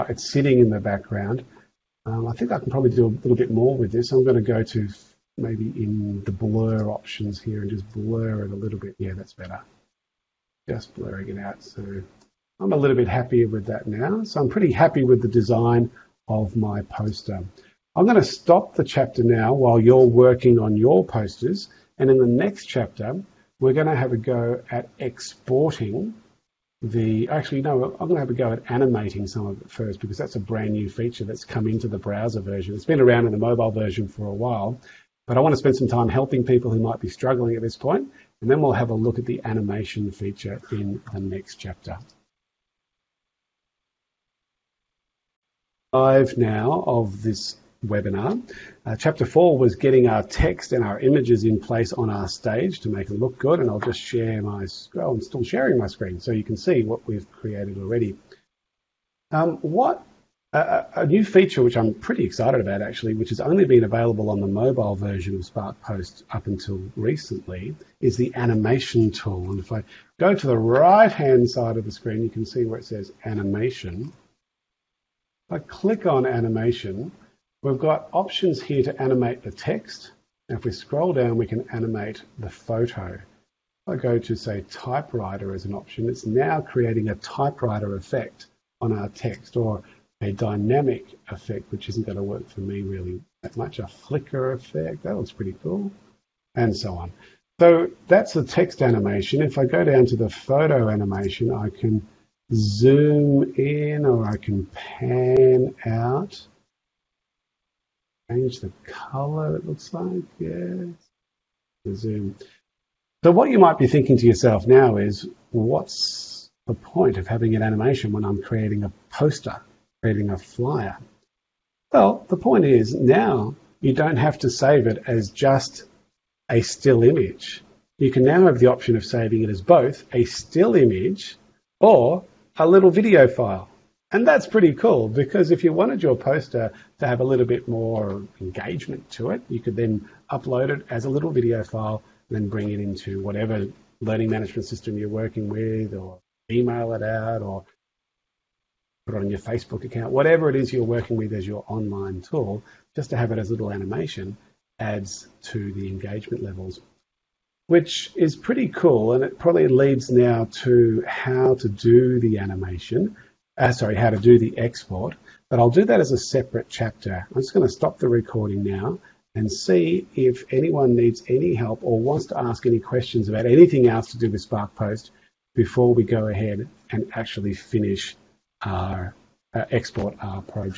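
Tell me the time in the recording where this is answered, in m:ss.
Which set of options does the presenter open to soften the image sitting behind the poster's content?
0:06.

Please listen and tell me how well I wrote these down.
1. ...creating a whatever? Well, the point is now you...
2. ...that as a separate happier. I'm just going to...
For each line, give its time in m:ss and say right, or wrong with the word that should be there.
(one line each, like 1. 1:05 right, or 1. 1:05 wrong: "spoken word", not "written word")
1. 2:00 wrong: "flyer", not "whatever"
2. 2:45 wrong: "chapter", not "happier".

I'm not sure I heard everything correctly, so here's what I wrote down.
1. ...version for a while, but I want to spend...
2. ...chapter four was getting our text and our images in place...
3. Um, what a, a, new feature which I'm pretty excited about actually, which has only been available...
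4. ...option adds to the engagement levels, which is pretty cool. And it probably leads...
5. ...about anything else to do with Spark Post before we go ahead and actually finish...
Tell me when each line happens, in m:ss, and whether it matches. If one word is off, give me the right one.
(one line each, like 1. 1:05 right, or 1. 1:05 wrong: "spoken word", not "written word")
1. 0:33 right
2. 0:48 right
3. 0:59 right
4. 2:33 wrong: "animation", not "option"
5. 2:53 right.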